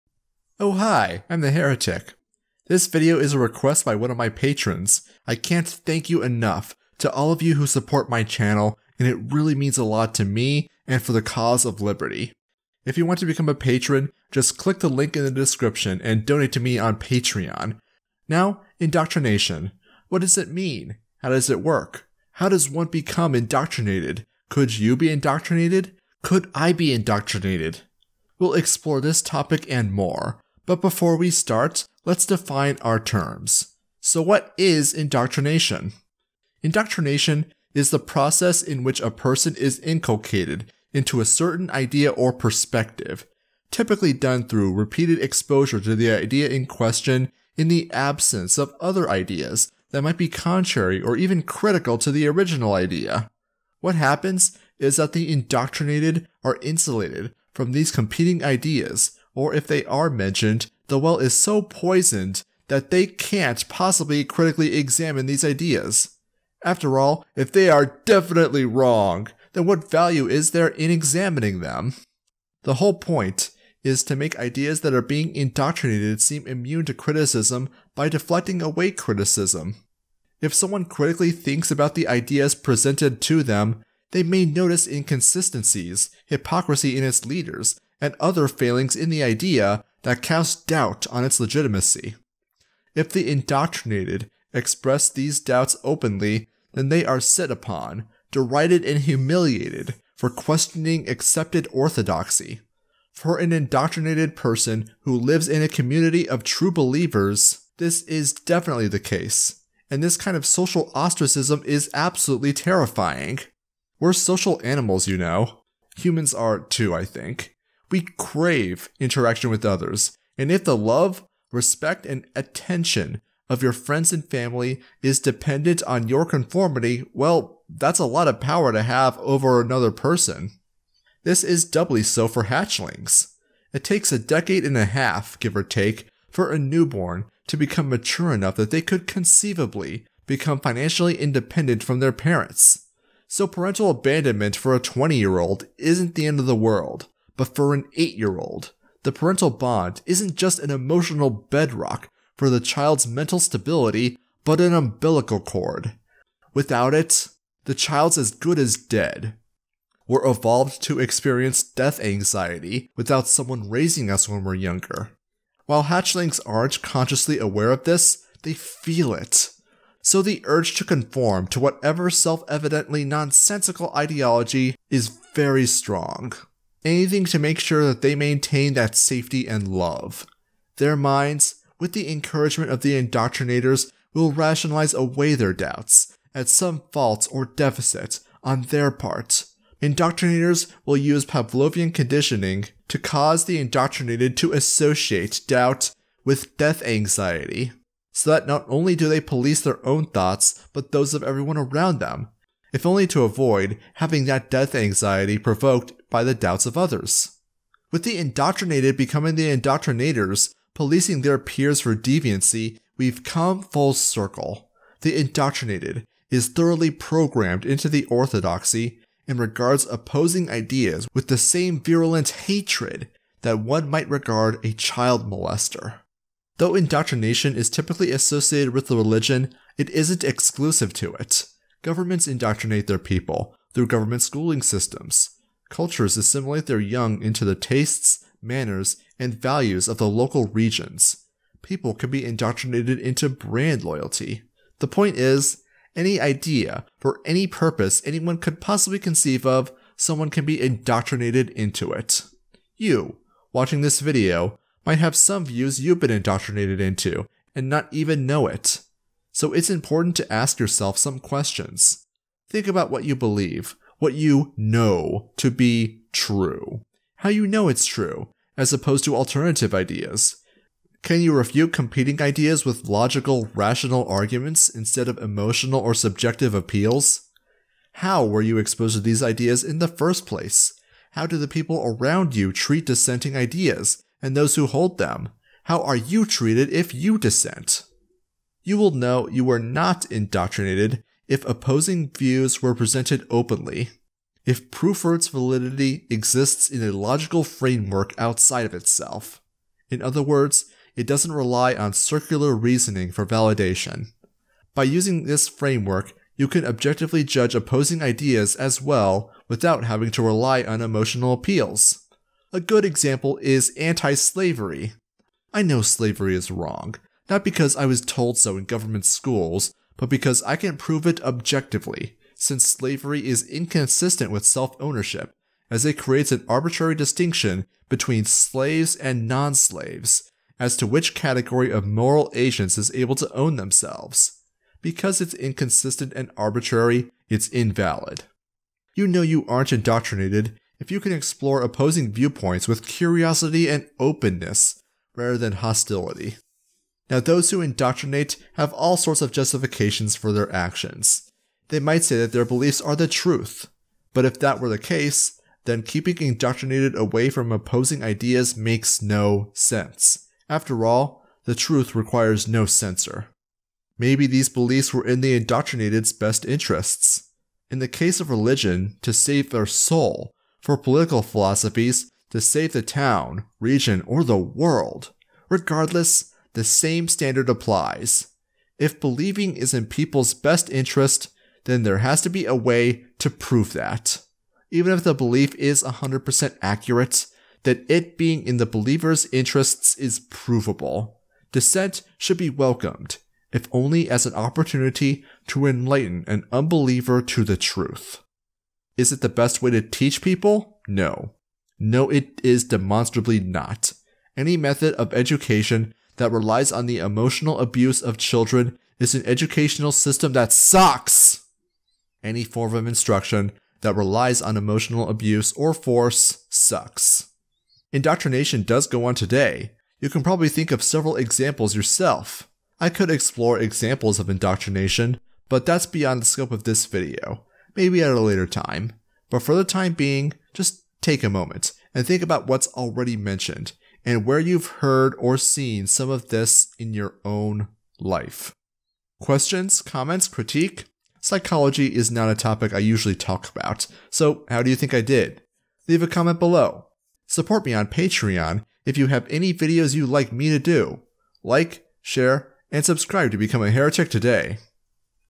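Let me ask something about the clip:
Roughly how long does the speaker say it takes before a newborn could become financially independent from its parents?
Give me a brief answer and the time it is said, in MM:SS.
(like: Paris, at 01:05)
a decade and a half, at 02:14.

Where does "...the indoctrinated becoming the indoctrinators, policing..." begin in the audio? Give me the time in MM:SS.
03:28.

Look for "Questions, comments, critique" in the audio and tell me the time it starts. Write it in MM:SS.
07:19.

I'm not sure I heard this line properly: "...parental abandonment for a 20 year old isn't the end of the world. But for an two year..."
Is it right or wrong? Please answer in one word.
wrong.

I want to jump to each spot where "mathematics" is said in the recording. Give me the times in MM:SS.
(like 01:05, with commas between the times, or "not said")
not said.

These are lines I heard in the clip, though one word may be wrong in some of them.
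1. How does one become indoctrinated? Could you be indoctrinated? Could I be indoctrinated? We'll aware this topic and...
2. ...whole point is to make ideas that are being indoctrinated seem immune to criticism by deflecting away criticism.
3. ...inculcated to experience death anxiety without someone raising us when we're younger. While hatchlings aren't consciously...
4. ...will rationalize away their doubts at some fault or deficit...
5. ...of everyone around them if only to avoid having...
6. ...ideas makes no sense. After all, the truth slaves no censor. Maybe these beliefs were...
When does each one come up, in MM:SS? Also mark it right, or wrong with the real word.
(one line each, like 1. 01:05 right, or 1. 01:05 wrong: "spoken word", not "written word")
1. 00:22 wrong: "explore", not "aware"
2. 01:12 right
3. 02:40 wrong: "evolved", not "inculcated"
4. 03:04 right
5. 03:21 right
6. 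05:58 wrong: "requires", not "slaves".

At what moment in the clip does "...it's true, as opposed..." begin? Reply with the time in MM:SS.
04:27.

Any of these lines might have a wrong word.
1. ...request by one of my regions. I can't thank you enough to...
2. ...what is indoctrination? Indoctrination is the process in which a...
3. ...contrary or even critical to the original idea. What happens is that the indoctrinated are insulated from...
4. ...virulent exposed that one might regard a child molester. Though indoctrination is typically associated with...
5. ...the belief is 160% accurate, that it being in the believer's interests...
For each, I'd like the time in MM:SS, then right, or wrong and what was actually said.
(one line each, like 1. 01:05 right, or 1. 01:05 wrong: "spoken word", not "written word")
1. 00:03 wrong: "patrons", not "regions"
2. 00:34 right
3. 00:50 right
4. 03:41 wrong: "hatred", not "exposed"
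5. 06:25 wrong: "100", not "160".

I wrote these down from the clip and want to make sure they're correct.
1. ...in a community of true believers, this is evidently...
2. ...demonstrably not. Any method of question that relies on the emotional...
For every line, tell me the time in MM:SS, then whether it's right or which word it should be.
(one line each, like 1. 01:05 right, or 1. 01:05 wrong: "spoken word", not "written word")
1. 01:45 wrong: "definitely", not "evidently"
2. 06:42 wrong: "education", not "question".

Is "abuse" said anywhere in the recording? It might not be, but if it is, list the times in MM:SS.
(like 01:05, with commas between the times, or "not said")
06:47, 06:55.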